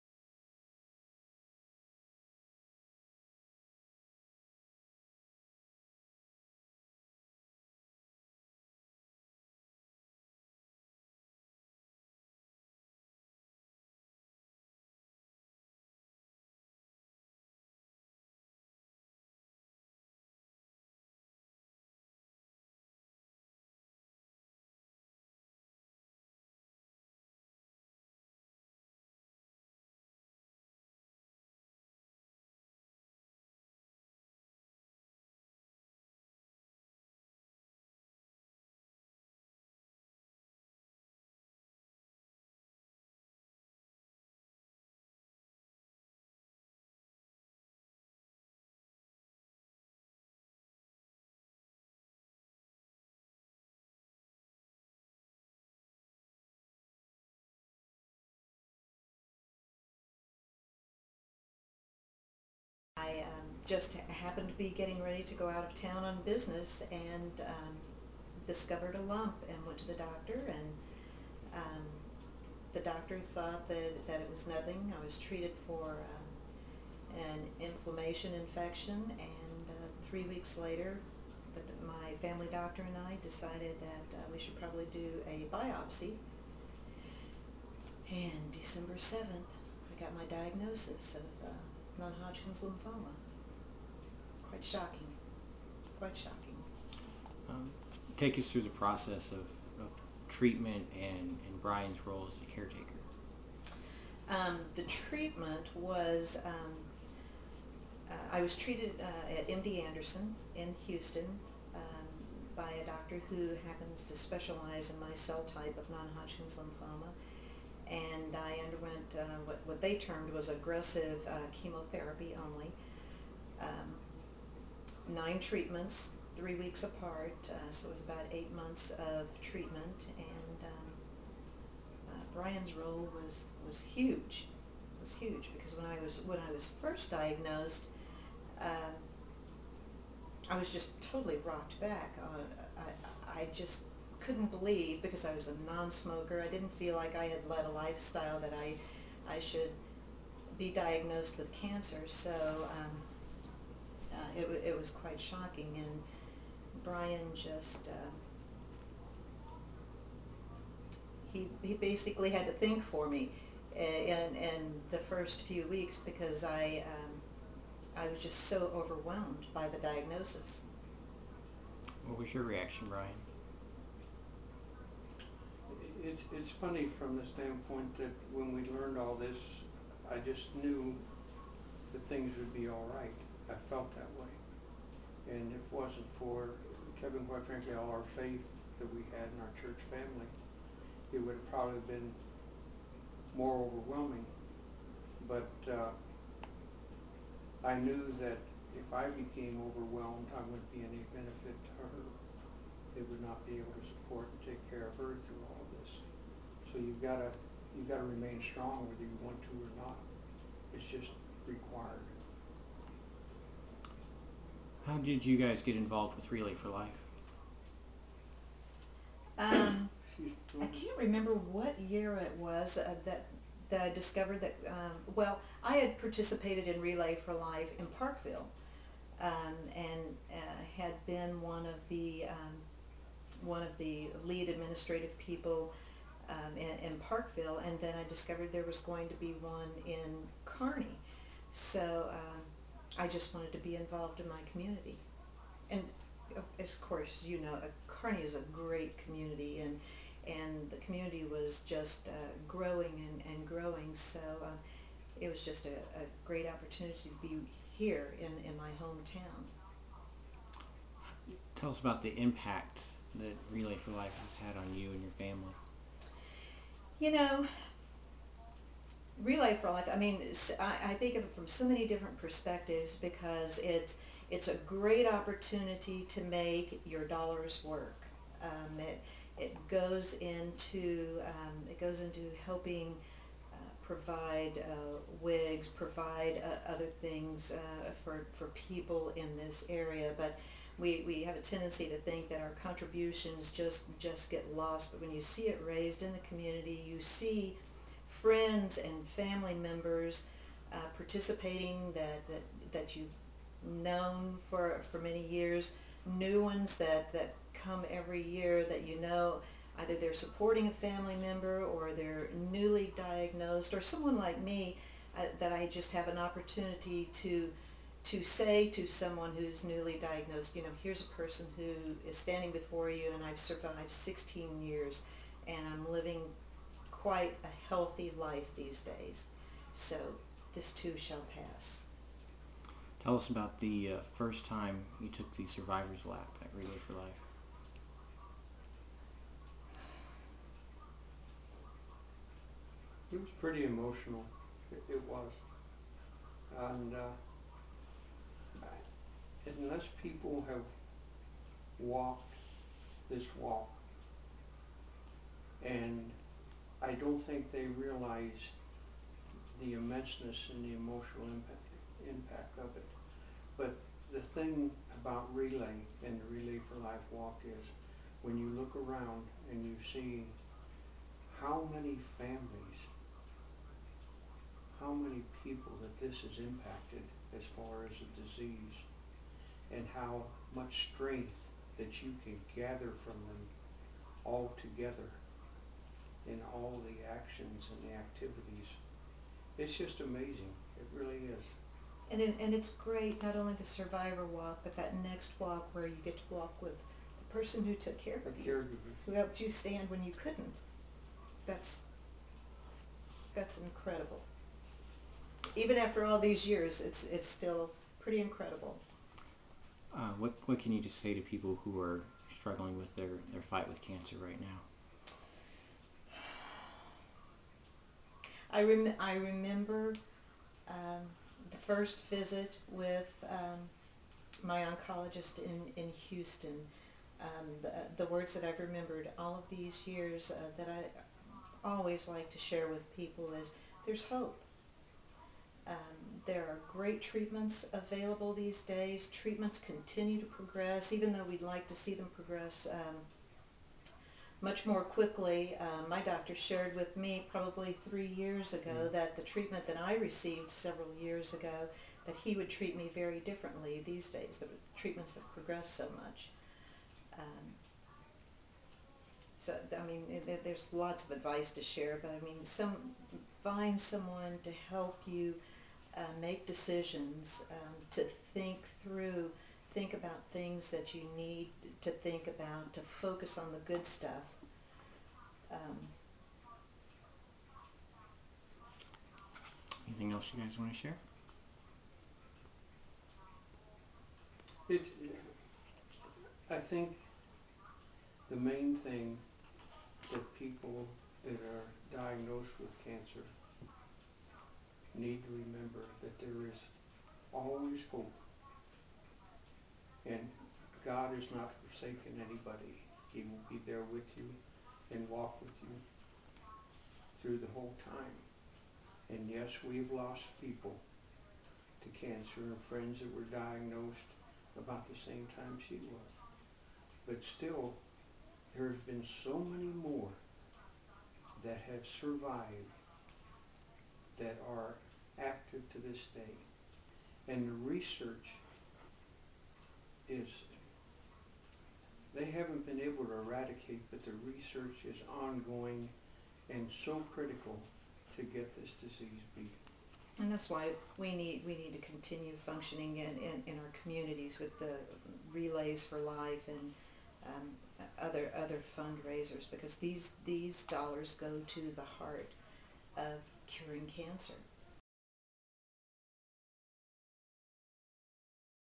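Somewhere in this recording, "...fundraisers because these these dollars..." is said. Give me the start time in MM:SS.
09:08.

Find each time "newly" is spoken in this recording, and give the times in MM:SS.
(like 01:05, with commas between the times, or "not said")
05:12, 05:19.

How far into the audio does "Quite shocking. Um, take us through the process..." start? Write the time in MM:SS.
01:35.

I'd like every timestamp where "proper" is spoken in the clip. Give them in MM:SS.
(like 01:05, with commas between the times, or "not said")
not said.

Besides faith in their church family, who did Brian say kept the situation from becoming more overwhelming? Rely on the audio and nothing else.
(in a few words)
Kevin.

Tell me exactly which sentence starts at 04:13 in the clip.
So uh, it was just a, a, great opportunity to be here in, in my hometown.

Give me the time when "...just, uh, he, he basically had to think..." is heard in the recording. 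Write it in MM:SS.
02:37.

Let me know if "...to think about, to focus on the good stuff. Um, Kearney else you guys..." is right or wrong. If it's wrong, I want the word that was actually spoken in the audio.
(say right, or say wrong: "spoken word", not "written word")
wrong: "Anything", not "Kearney".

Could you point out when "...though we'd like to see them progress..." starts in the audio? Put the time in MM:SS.
07:21.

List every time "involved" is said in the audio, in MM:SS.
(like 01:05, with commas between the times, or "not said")
03:35, 04:03.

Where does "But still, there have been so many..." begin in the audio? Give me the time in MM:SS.
08:37.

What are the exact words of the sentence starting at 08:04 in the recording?
It, I think the main thing that people that are diagnosed with cancer need to remember that there is always hope.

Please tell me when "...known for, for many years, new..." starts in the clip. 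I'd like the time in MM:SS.
05:03.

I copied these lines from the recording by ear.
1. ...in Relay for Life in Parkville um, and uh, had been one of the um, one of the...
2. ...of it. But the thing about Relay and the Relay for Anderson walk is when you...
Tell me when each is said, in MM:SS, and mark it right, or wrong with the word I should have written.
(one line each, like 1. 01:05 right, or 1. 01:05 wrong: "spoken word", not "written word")
1. 03:46 right
2. 06:02 wrong: "Life", not "Anderson".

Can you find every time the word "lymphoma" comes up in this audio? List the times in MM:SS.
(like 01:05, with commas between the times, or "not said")
01:32, 01:56.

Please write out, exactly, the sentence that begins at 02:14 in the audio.
It was huge because when I was when I was first diagnosed, um, I was just totally rocked back.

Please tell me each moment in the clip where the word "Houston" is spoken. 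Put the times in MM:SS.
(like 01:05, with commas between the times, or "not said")
01:50, 07:06.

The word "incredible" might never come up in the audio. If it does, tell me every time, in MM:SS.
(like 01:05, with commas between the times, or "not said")
06:43, 06:48.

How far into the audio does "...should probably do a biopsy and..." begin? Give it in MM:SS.
01:24.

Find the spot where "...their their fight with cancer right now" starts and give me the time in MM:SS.
06:52.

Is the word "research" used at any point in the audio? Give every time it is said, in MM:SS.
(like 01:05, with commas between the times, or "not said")
08:47, 08:54.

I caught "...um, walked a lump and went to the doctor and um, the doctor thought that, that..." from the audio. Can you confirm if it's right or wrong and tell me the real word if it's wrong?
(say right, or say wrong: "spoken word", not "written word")
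wrong: "discovered", not "walked".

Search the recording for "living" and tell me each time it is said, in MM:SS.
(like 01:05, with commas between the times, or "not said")
05:25.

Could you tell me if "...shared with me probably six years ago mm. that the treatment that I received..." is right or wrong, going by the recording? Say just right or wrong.
wrong.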